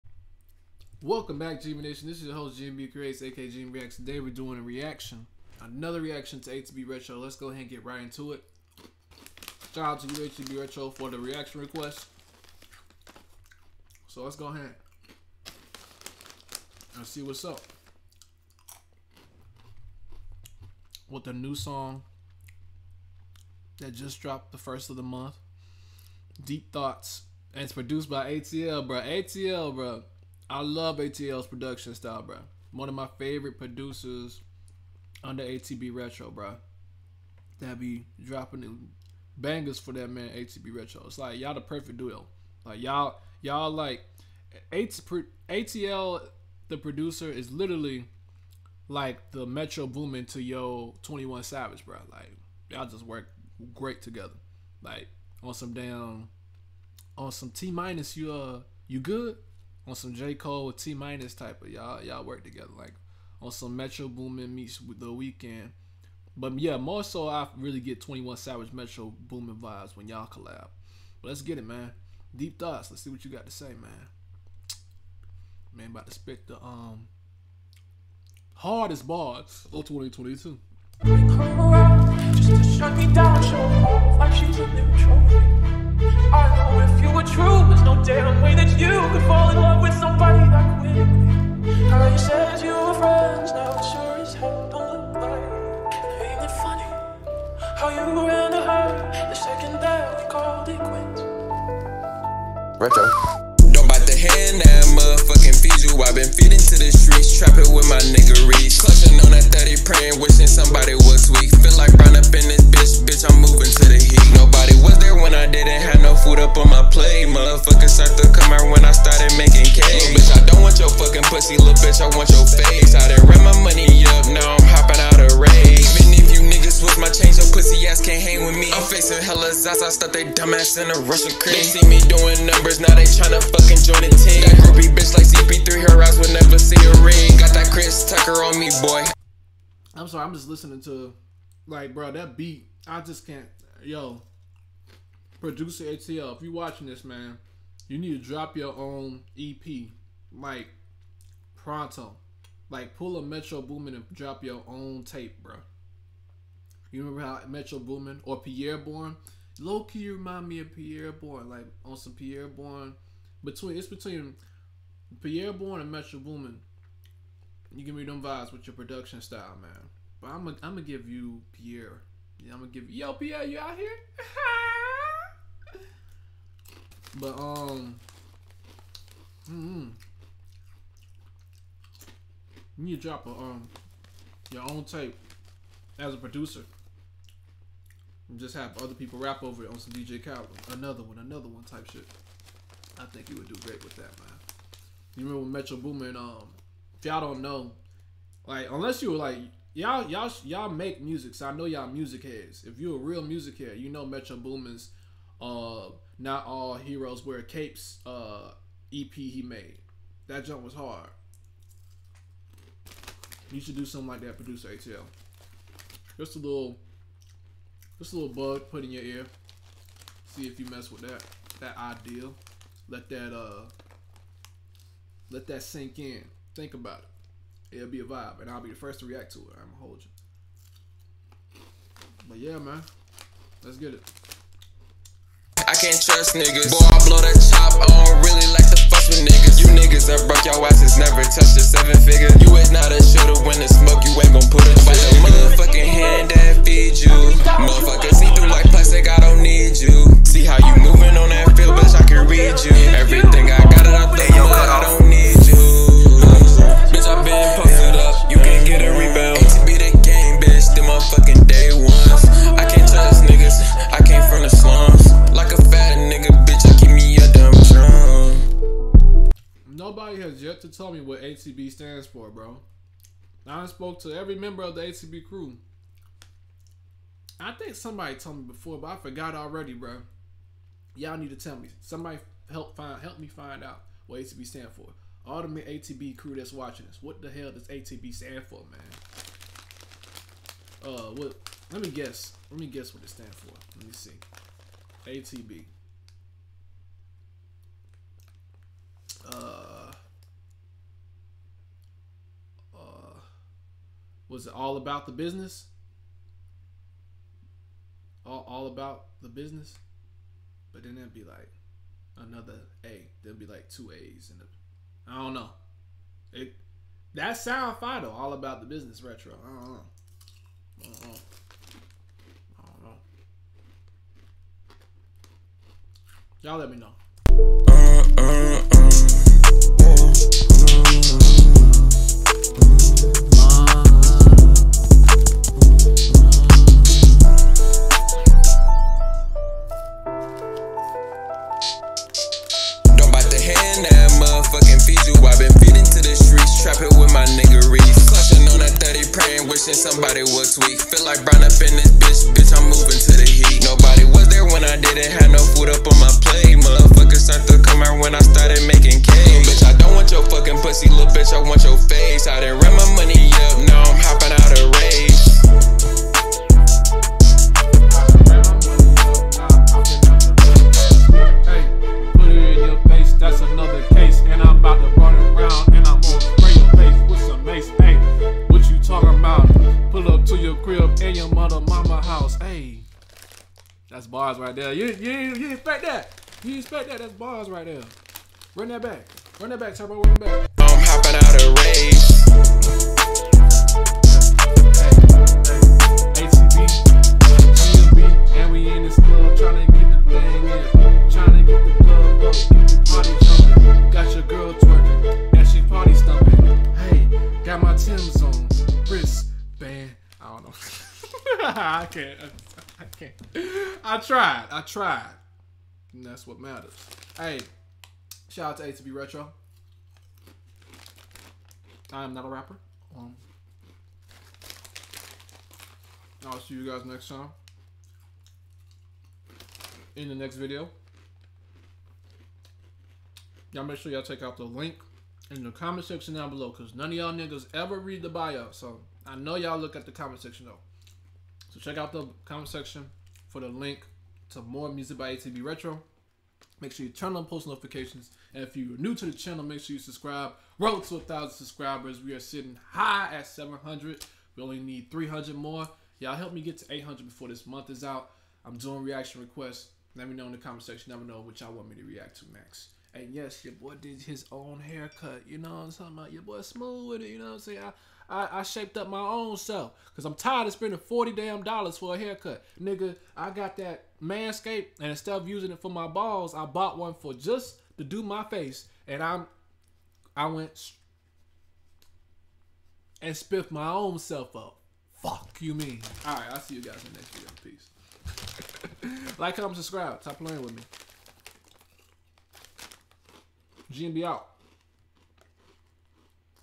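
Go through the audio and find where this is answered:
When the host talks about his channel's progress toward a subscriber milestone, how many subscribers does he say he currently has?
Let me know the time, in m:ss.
7:33.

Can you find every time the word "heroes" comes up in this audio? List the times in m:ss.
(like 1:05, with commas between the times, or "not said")
3:26.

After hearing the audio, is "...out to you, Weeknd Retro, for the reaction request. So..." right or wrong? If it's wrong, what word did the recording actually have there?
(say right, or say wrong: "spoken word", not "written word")
wrong: "ATB", not "Weeknd".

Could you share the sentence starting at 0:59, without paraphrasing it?
on some J Cole T minus type of y'all y'all work together like on some Metro Boomin meets the Weeknd.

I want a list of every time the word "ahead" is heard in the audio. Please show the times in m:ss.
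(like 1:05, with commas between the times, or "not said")
0:07, 0:14.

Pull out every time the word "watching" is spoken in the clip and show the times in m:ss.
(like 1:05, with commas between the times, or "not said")
2:26, 4:46.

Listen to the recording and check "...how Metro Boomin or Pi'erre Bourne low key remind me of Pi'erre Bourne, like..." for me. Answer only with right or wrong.
right.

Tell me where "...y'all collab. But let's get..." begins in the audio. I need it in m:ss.
1:10.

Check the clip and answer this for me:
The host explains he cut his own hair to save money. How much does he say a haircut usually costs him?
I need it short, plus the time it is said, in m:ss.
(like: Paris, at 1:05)
$40, at 7:50.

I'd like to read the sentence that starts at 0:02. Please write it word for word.
This is your host, GMB Creates, aka GMB Reacts.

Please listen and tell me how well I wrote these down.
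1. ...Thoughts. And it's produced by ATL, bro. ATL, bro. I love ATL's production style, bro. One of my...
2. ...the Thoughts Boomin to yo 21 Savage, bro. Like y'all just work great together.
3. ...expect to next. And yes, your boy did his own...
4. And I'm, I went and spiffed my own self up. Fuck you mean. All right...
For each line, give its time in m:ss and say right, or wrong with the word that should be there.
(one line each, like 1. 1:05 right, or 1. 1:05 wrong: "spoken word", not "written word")
1. 0:26 right
2. 0:49 wrong: "Metro", not "Thoughts"
3. 7:41 wrong: "react", not "expect"
4. 7:58 right.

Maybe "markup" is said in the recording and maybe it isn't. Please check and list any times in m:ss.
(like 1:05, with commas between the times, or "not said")
not said.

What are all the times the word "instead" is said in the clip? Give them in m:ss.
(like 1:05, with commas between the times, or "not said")
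7:54.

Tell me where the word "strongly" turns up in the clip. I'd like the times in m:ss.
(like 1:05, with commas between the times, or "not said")
not said.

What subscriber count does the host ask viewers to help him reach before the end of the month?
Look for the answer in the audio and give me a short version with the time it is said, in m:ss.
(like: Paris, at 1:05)
800, at 7:36.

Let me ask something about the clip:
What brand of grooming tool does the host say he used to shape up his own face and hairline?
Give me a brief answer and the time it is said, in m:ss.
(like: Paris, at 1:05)
Manscaped, at 7:54.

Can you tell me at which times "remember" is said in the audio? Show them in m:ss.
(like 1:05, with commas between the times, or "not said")
2:37, 3:15.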